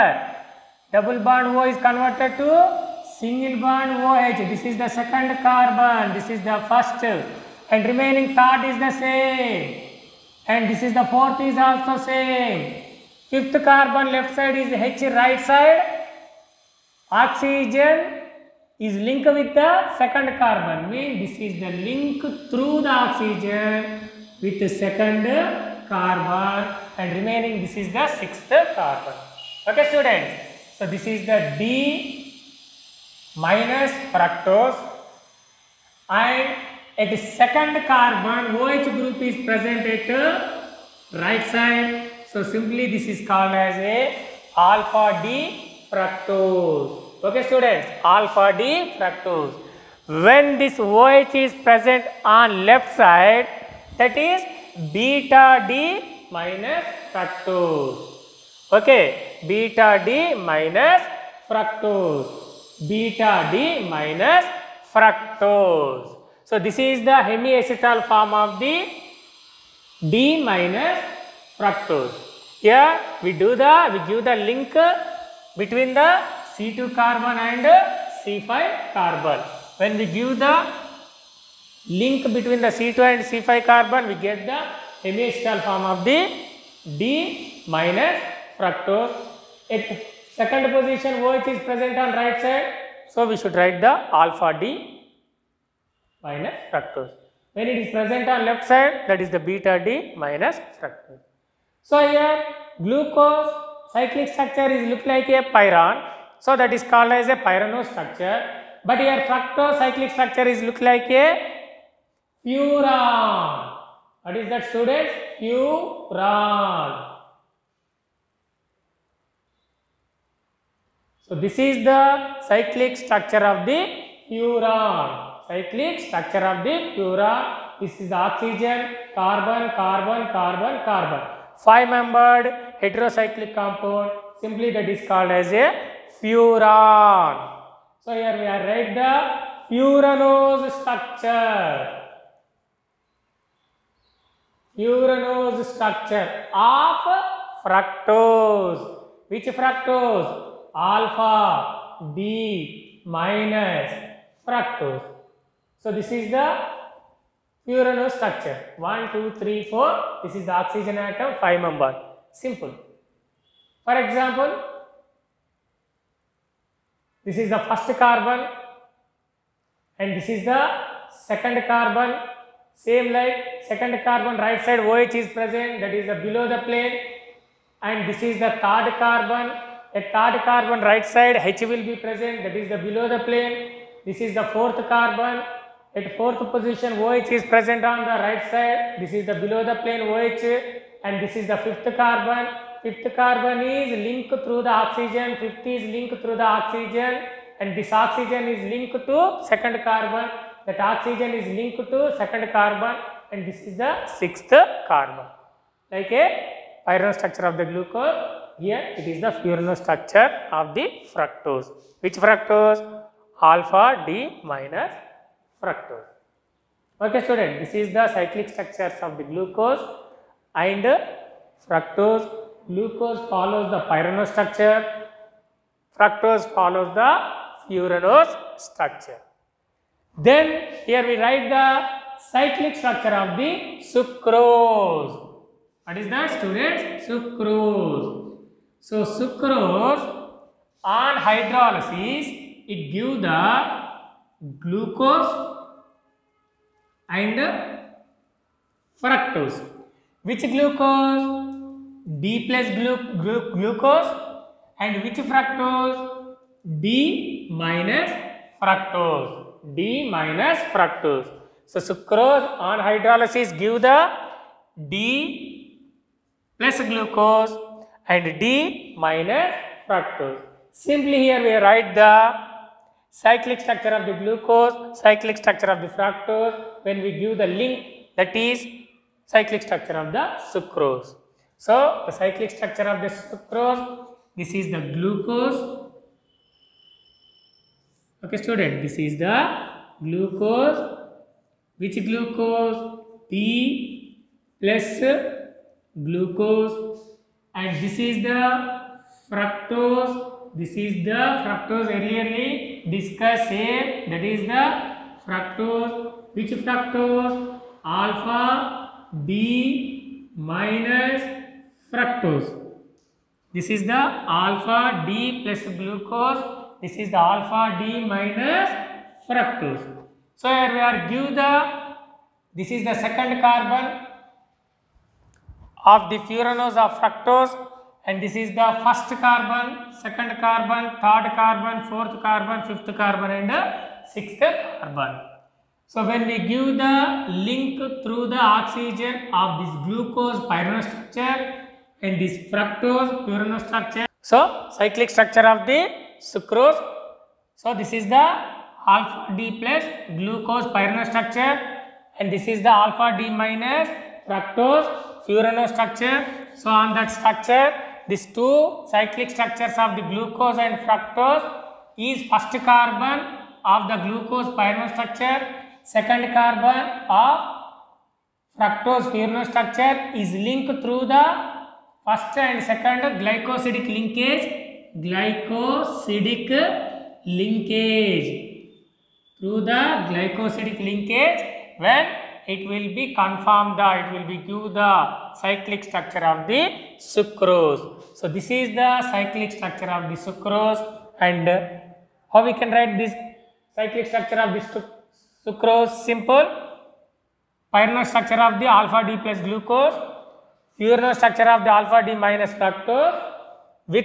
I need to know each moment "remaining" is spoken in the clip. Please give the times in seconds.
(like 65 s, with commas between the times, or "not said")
7 s, 27 s.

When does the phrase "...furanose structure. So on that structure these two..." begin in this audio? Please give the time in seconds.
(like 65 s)
355 s.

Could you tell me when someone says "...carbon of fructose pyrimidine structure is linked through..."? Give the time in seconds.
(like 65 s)
366 s.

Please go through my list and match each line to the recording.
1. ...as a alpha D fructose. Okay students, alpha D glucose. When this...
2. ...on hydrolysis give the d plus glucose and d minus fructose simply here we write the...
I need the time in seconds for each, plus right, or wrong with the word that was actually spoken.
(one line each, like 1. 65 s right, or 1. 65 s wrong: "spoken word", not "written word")
1. 43 s wrong: "fructose", not "glucose"
2. 262 s right.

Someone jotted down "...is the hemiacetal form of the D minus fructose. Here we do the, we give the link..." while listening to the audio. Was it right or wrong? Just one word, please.
right.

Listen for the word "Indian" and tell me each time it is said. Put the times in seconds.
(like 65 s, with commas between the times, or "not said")
not said.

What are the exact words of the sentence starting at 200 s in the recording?
That oxygen is linked to second carbon and this is the sixth carbon.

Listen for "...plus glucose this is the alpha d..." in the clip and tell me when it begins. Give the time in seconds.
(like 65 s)
315 s.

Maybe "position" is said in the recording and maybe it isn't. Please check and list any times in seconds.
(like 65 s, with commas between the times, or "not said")
90 s, 186 s.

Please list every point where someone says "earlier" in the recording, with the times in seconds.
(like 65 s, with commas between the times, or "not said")
301 s.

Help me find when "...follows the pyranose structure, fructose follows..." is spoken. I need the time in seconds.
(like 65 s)
223 s.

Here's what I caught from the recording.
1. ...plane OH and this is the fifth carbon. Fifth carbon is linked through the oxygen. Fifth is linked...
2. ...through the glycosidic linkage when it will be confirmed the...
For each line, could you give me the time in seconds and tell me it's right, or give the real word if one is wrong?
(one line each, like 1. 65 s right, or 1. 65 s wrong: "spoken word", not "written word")
1. 189 s right
2. 379 s right.